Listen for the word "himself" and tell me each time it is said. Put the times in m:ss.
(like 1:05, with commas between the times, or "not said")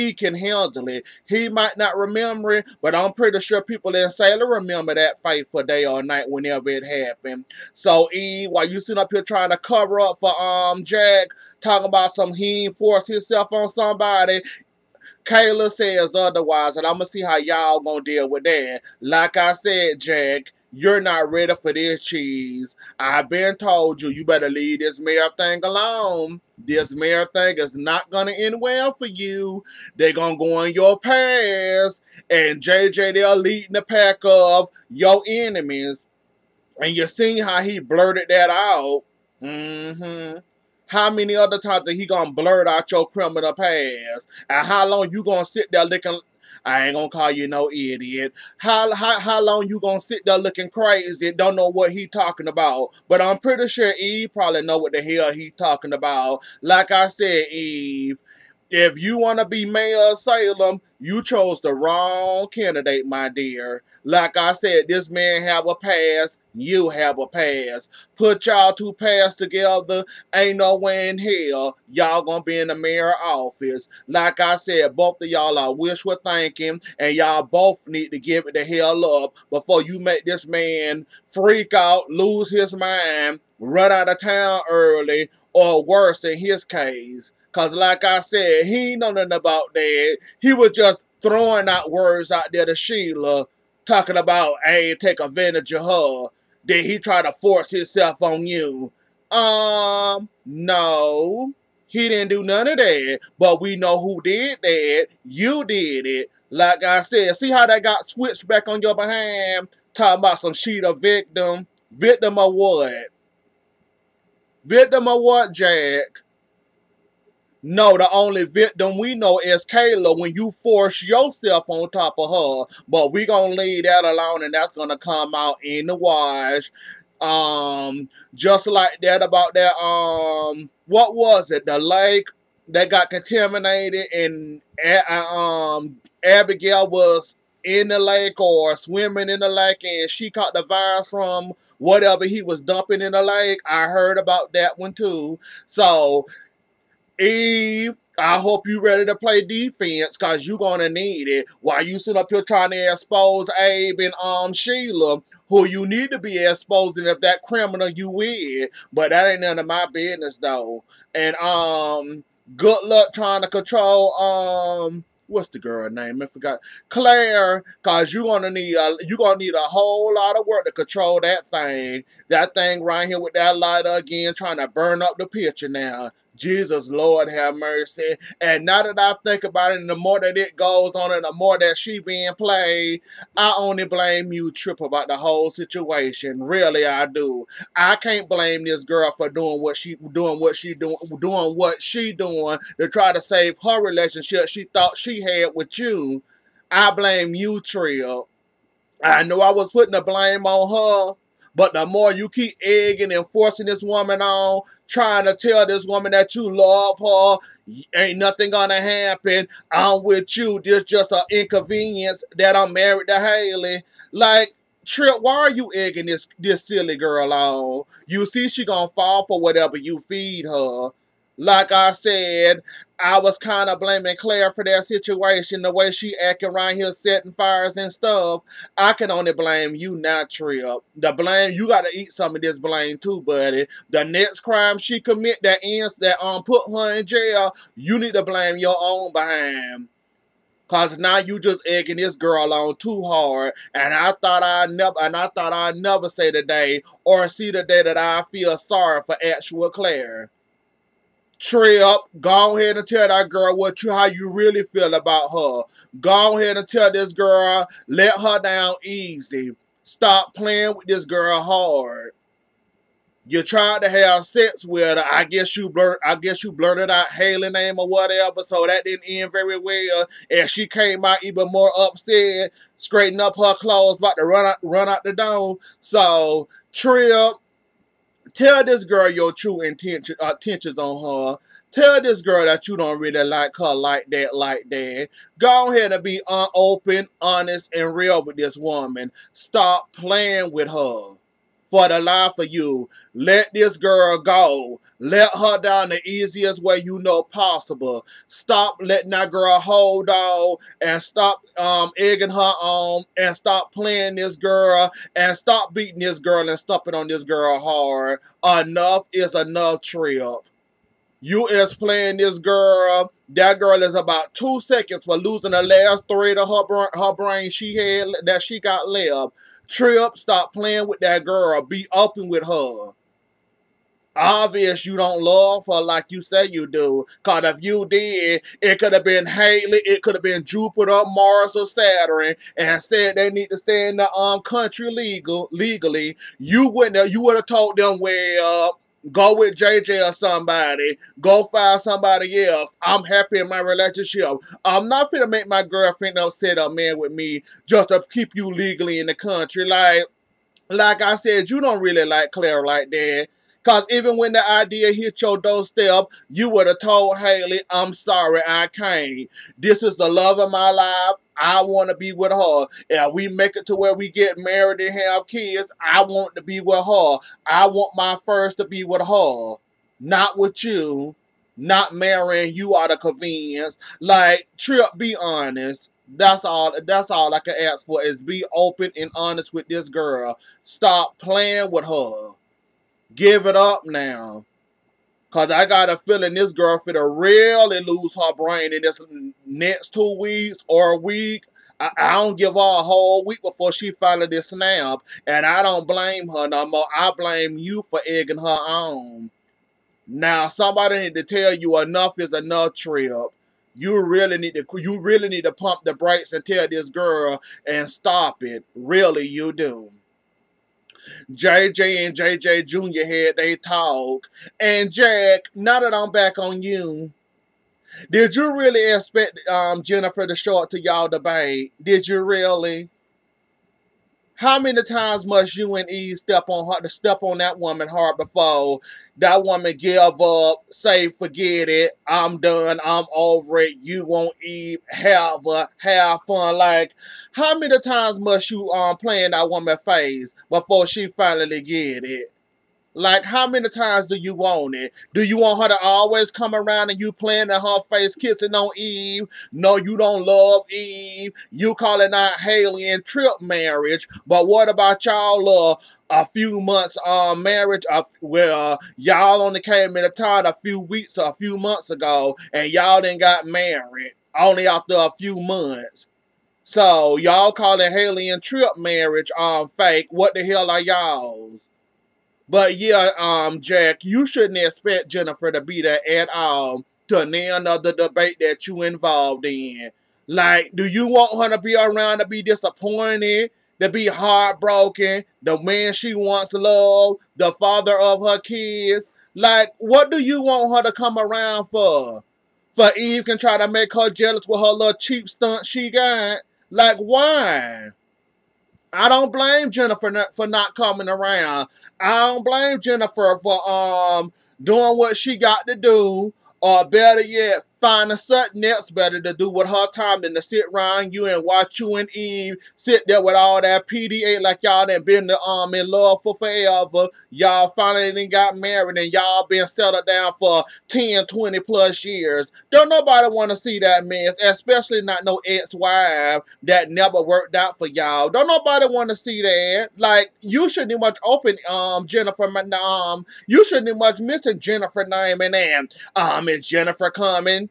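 0:13, 1:37.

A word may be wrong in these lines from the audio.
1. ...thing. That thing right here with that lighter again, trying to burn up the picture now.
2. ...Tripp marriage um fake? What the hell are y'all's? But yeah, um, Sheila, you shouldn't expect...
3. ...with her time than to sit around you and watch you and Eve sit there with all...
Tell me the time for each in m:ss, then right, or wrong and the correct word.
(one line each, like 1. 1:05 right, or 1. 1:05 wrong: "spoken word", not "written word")
1. 2:51 right
2. 7:48 wrong: "Jack", not "Sheila"
3. 8:29 right.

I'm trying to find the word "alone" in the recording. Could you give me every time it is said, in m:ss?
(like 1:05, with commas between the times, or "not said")
0:25, 2:04.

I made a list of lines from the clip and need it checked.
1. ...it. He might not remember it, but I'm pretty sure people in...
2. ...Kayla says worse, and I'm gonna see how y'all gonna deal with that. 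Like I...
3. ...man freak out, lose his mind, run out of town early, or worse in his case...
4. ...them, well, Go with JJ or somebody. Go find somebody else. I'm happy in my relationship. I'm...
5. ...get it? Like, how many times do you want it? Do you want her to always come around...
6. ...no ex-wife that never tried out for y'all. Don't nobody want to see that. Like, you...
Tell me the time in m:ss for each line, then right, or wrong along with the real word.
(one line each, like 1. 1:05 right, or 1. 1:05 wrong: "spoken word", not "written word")
1. 0:00 right
2. 0:15 wrong: "otherwise", not "worse"
3. 1:20 right
4. 5:37 right
5. 7:21 right
6. 8:45 wrong: "worked", not "tried".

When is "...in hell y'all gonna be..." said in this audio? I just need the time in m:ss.
1:11.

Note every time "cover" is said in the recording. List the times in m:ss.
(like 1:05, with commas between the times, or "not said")
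0:09.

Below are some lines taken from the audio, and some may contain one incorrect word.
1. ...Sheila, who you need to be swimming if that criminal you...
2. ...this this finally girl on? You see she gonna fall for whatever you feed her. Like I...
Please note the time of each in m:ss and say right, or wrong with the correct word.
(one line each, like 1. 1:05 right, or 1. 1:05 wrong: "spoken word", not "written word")
1. 2:34 wrong: "exposing", not "swimming"
2. 3:36 wrong: "silly", not "finally".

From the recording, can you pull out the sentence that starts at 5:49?
Like, like I said, you don't really like Claire like that.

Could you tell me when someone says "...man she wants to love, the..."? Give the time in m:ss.
8:05.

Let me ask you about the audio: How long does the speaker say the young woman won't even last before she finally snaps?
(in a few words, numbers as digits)
a whole week.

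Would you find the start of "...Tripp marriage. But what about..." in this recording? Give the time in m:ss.
7:33.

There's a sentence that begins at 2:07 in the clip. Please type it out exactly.
Um, just like that about that, um, what was it?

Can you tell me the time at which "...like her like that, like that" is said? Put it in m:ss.
4:43.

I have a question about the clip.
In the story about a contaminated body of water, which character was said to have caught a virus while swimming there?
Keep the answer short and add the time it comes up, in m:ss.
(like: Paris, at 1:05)
Abigail, at 2:16.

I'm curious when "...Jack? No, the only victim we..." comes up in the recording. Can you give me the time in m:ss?
1:55.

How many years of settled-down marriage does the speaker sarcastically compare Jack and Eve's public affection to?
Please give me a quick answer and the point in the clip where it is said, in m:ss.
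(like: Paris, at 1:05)
10 to 20 plus years, at 8:40.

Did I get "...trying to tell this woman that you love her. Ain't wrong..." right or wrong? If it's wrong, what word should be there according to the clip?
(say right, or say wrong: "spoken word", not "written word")
wrong: "nothing", not "wrong".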